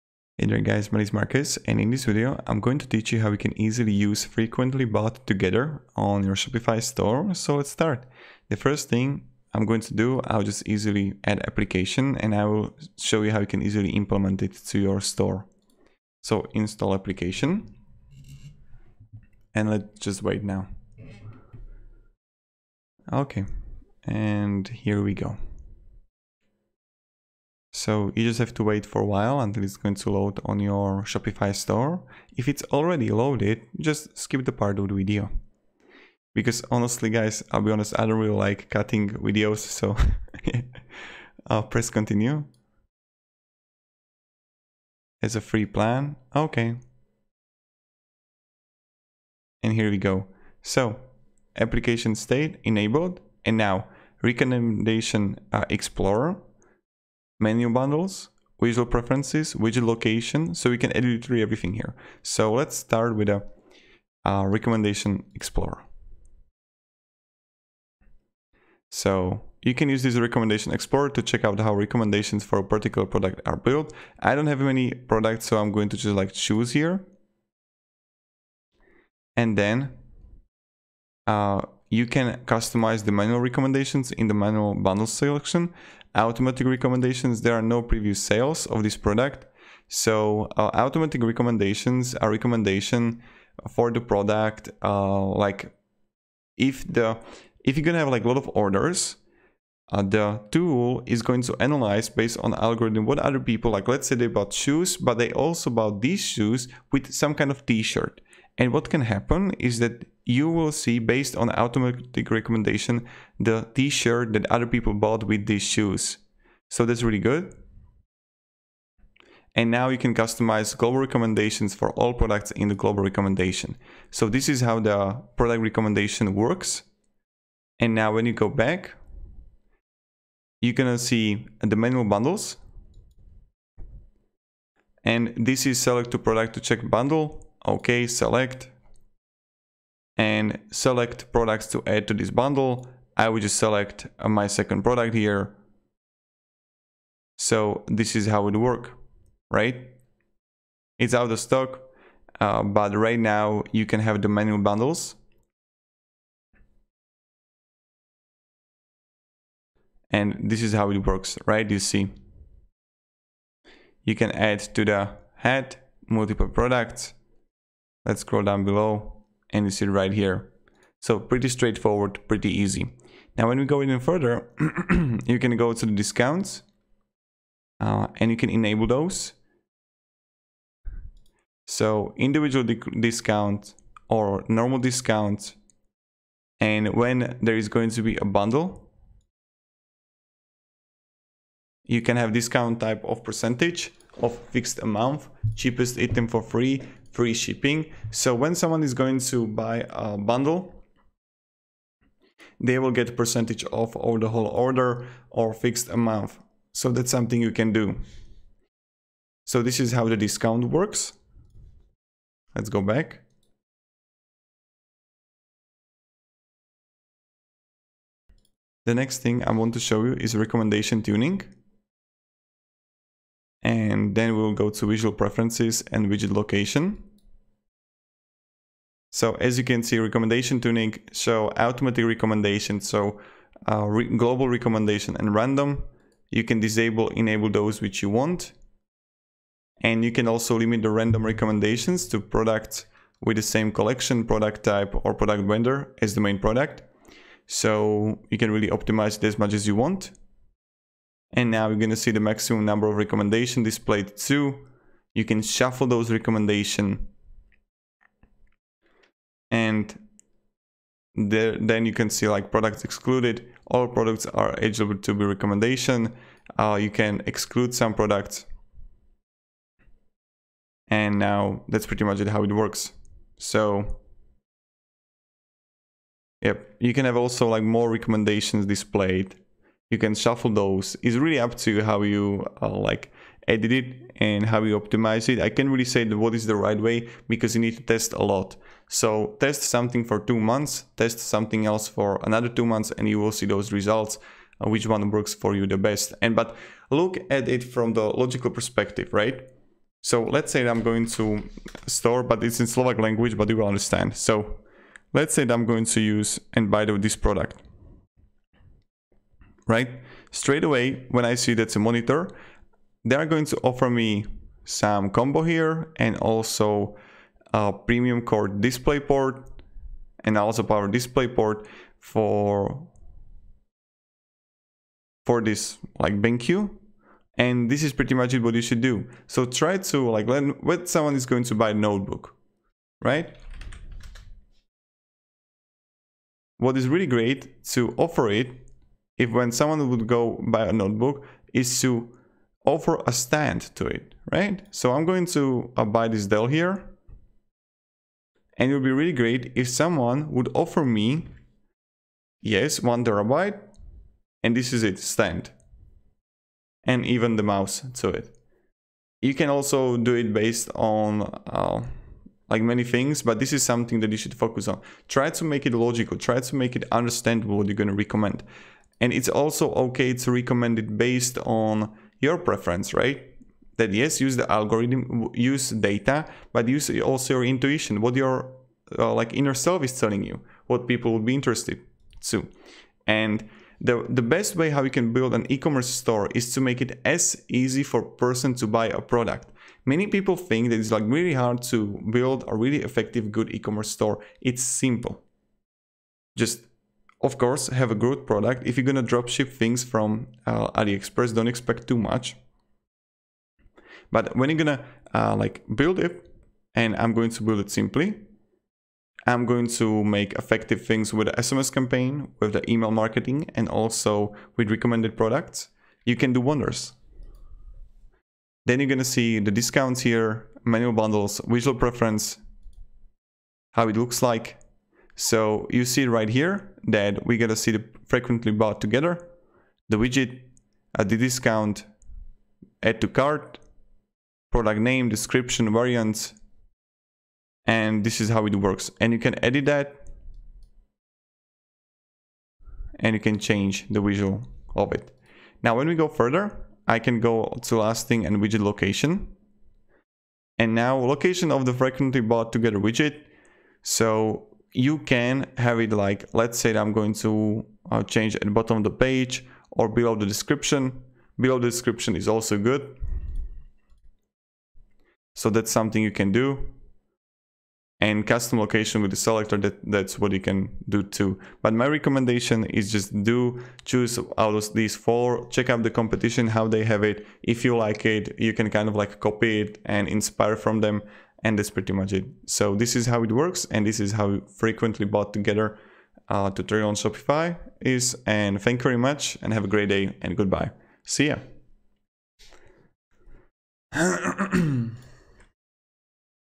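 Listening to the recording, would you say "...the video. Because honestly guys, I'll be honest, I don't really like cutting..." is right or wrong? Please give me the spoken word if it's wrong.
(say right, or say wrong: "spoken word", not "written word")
right.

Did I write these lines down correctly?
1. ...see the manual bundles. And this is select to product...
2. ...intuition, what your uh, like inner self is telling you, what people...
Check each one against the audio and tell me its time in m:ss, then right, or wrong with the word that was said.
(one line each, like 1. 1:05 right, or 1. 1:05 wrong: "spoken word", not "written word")
1. 2:10 right
2. 6:17 right.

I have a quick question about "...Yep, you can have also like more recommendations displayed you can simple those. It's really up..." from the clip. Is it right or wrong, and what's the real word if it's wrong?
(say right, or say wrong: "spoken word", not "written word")
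wrong: "shuffle", not "simple".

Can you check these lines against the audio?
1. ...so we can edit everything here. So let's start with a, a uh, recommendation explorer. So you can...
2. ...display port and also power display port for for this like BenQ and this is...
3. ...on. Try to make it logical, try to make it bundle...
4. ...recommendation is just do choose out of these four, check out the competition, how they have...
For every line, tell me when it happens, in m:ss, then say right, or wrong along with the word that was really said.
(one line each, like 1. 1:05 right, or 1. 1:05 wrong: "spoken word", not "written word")
1. 1:00 right
2. 5:18 right
3. 6:04 wrong: "understandable", not "bundle"
4. 7:51 right.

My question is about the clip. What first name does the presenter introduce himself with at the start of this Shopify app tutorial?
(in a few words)
Marcus.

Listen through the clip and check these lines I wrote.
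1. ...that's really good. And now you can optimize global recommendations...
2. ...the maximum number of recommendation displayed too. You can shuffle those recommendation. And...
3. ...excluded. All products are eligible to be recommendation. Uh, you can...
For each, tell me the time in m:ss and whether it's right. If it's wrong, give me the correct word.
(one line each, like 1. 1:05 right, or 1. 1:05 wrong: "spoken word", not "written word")
1. 1:56 wrong: "customize", not "optimize"
2. 4:12 right
3. 4:22 right.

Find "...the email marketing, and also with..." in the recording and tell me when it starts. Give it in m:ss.
6:52.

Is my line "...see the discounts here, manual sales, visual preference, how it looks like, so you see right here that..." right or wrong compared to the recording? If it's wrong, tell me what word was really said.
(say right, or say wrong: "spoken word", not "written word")
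wrong: "bundles", not "sales".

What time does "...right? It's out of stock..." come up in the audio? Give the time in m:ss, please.
2:29.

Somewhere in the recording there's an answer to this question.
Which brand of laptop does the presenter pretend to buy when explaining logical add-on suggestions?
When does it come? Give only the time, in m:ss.
5:46.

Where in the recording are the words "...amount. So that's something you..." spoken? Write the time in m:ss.
3:25.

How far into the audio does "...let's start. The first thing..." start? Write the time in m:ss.
0:07.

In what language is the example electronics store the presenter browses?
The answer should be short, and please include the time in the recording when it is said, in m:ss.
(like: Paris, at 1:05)
Slovak, at 5:02.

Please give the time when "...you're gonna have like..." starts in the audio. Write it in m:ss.
1:37.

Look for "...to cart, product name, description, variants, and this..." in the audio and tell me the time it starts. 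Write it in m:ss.
7:13.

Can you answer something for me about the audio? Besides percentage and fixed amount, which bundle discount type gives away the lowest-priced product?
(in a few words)
Cheapest item for free.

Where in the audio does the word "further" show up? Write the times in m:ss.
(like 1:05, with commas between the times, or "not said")
2:53, 7:26.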